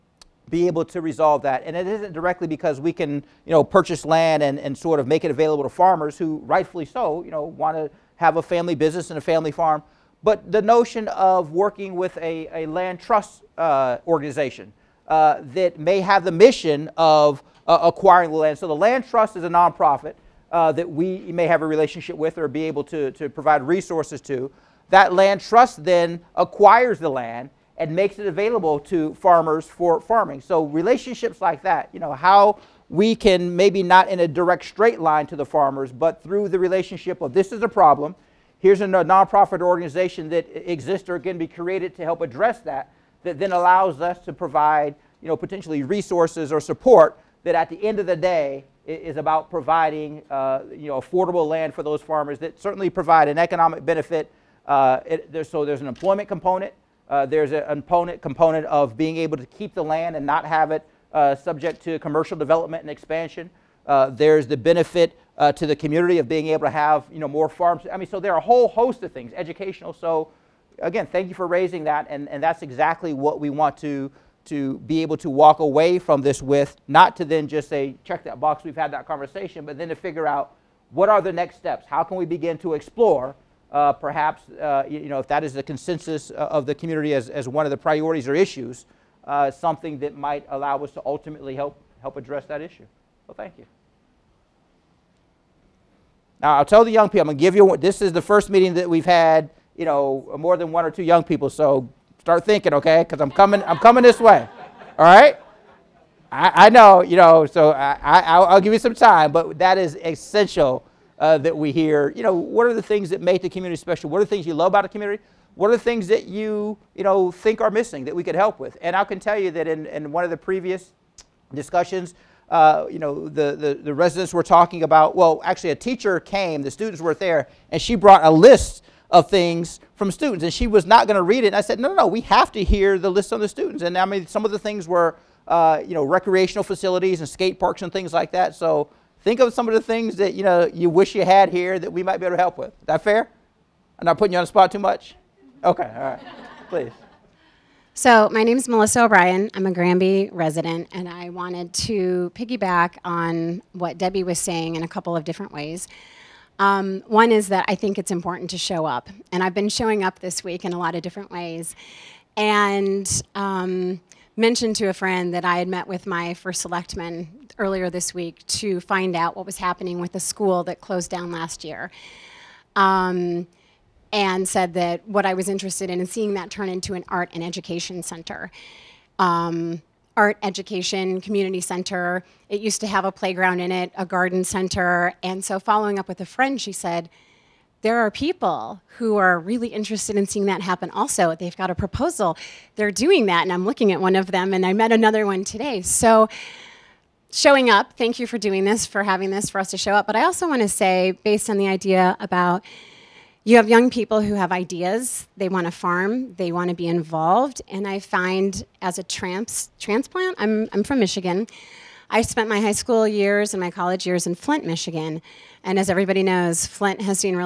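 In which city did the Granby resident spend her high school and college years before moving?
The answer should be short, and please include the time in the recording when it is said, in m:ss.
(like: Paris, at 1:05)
Flint, Michigan, at 3:34.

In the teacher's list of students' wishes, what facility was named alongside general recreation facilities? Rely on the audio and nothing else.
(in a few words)
skate parks.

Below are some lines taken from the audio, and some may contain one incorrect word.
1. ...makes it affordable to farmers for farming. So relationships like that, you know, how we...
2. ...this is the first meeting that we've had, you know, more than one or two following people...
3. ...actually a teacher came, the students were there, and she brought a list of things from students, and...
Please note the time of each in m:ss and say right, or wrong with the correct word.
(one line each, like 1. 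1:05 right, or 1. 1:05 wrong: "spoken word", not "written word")
1. 0:27 wrong: "available", not "affordable"
2. 1:37 wrong: "young", not "following"
3. 2:05 right.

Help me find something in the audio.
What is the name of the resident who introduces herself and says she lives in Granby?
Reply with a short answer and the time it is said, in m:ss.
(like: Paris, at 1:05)
Melissa O'Brien, at 2:28.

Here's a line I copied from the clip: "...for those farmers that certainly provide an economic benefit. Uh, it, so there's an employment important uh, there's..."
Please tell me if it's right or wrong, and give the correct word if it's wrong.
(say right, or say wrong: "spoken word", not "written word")
wrong: "component", not "important".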